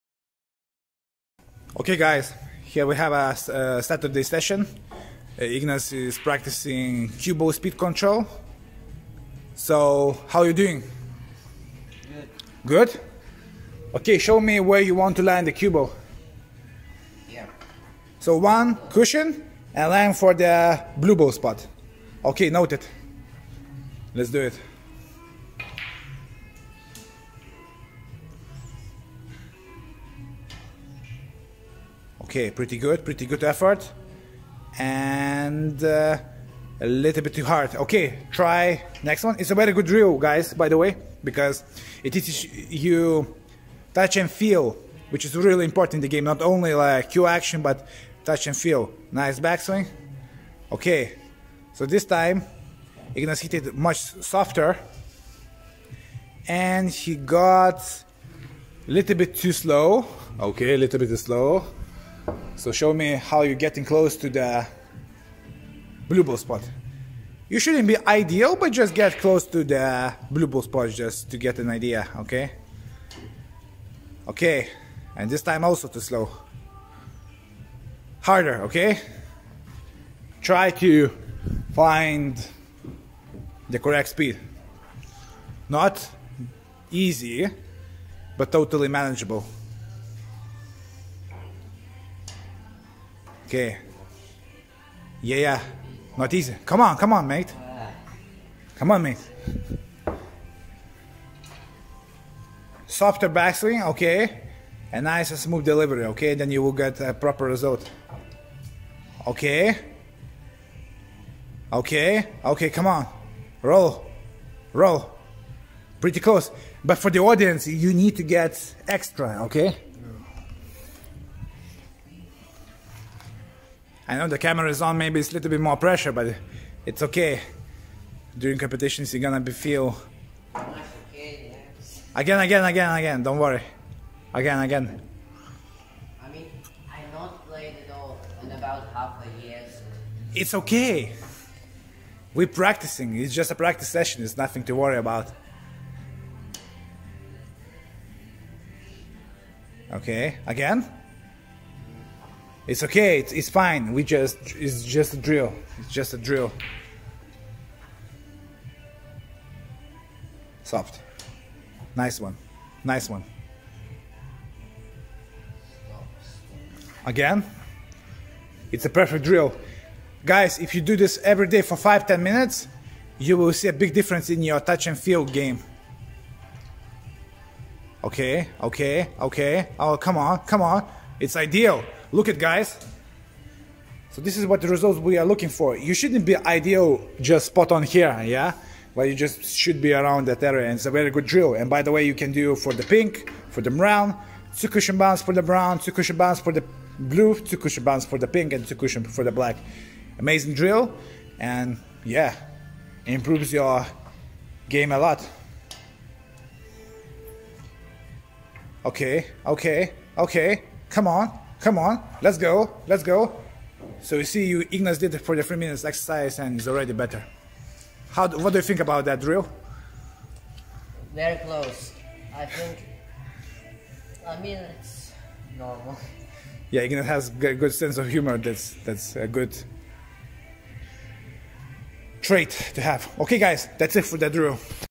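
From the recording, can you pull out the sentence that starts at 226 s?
Yeah, Ignas has a good sense of humor.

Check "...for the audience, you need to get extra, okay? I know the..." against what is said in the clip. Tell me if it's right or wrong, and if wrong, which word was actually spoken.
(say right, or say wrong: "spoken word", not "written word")
right.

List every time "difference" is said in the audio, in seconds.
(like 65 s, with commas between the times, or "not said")
173 s.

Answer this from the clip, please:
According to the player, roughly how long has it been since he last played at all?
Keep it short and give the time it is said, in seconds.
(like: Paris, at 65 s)
Half a year, at 138 s.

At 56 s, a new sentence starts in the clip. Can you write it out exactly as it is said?
And he got a little bit too slow.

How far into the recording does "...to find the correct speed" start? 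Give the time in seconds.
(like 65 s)
80 s.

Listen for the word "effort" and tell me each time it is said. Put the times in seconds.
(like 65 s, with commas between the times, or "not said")
33 s.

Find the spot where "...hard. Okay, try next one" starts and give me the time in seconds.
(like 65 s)
37 s.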